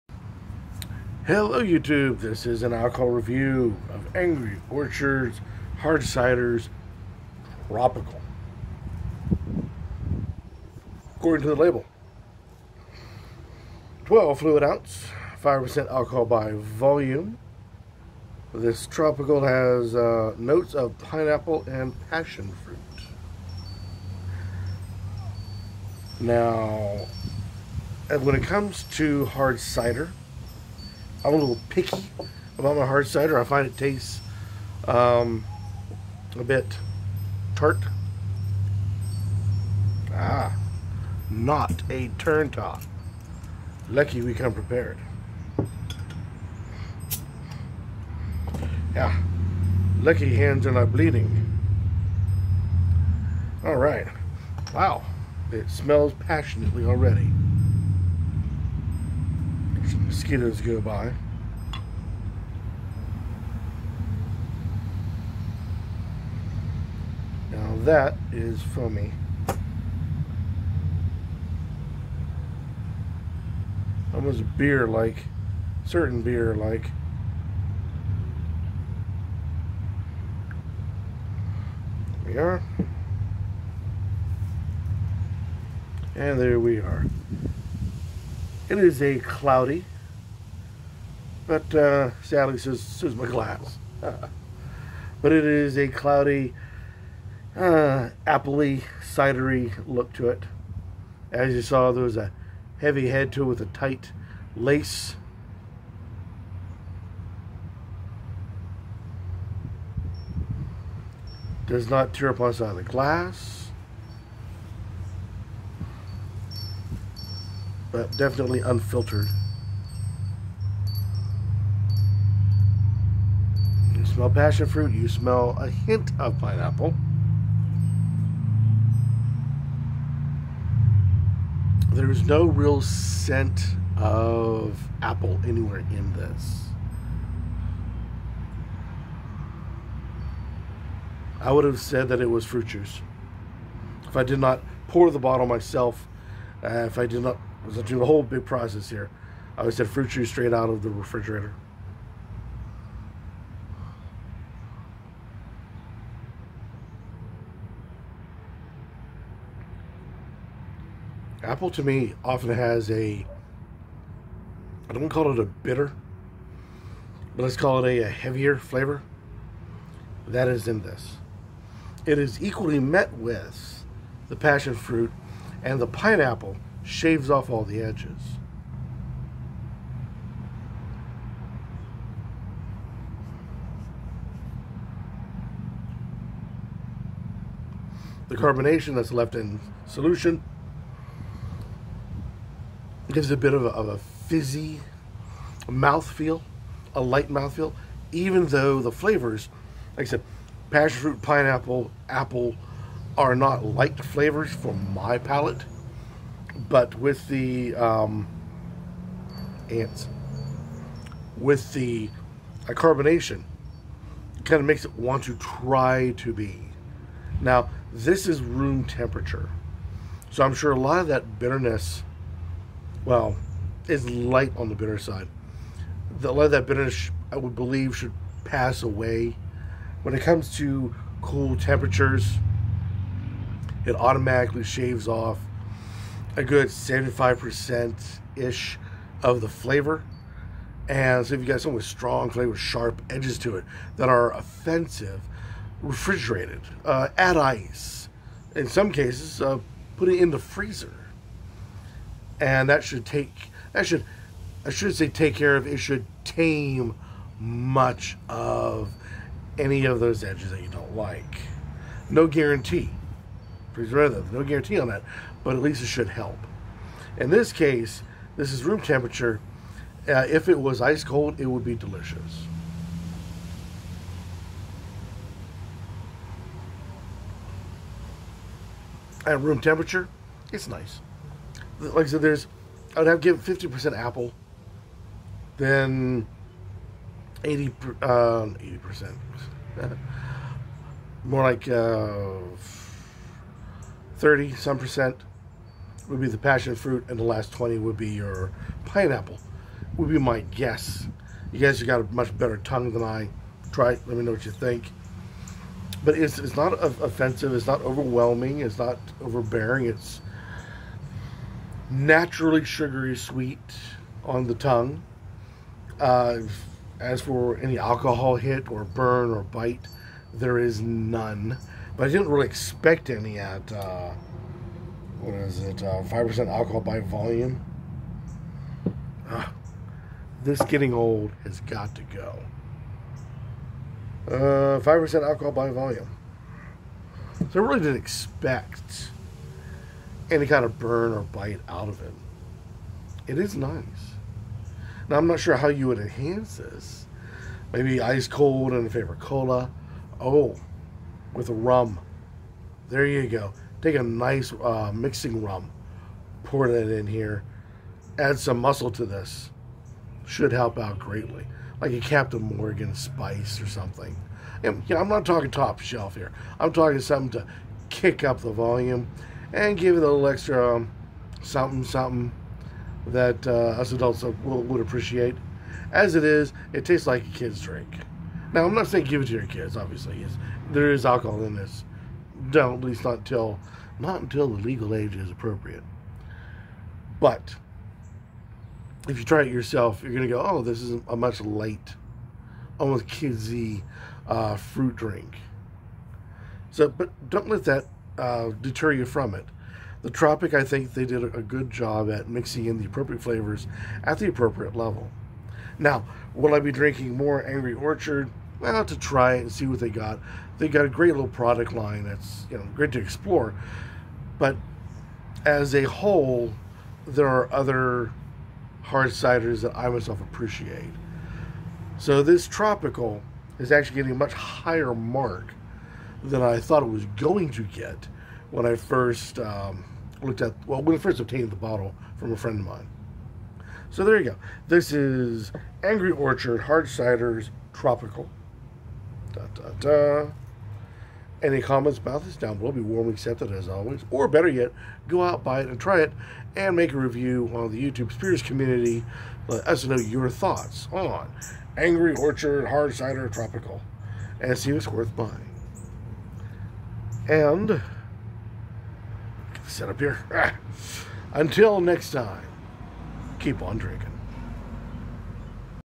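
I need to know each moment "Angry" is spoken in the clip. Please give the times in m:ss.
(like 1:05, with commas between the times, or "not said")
0:04, 6:47, 7:15, 7:31.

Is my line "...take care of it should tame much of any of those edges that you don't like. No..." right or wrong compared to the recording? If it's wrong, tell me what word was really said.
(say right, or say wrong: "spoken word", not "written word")
right.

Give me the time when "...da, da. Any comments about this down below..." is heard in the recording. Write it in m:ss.
7:19.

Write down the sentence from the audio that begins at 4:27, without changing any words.
In this case, this is room temperature.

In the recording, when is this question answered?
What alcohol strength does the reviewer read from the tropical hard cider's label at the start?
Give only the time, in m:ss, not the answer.
0:15.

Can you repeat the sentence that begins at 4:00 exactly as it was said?
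And so if you got something with strong flavor, sharp edges to it that are offensive, refrigerated, uh, add ice.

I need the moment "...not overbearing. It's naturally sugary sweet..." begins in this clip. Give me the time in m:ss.
5:08.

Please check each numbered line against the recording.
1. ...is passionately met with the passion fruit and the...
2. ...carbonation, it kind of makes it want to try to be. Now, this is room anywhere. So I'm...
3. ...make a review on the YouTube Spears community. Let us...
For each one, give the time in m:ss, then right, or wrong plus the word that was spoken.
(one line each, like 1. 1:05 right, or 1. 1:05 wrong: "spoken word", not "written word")
1. 2:52 wrong: "equally", not "passionately"
2. 3:32 wrong: "temperature", not "anywhere"
3. 7:26 right.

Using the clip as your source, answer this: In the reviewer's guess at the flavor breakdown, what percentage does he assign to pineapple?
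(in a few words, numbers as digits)
20%.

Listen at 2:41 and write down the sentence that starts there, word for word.
Apple to me often has a, I don't call it a bitter, but let's call it a, a heavier flavor.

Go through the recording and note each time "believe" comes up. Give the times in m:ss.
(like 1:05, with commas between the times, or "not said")
3:47.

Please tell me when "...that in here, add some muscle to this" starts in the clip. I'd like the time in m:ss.
5:56.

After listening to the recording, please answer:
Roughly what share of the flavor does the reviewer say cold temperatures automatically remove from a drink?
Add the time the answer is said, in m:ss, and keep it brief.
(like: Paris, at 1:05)
75%, at 3:56.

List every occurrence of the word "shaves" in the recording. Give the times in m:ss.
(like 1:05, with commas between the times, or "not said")
2:56, 3:54.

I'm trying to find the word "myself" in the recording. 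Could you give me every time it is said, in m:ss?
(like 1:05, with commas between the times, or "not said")
2:25, 6:59.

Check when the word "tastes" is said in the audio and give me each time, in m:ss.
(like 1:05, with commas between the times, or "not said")
0:33, 6:16.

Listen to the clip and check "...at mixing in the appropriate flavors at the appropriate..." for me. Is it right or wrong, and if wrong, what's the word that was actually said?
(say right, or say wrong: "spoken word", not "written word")
right.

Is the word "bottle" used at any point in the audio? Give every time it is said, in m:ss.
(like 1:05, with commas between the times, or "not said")
2:25, 7:11.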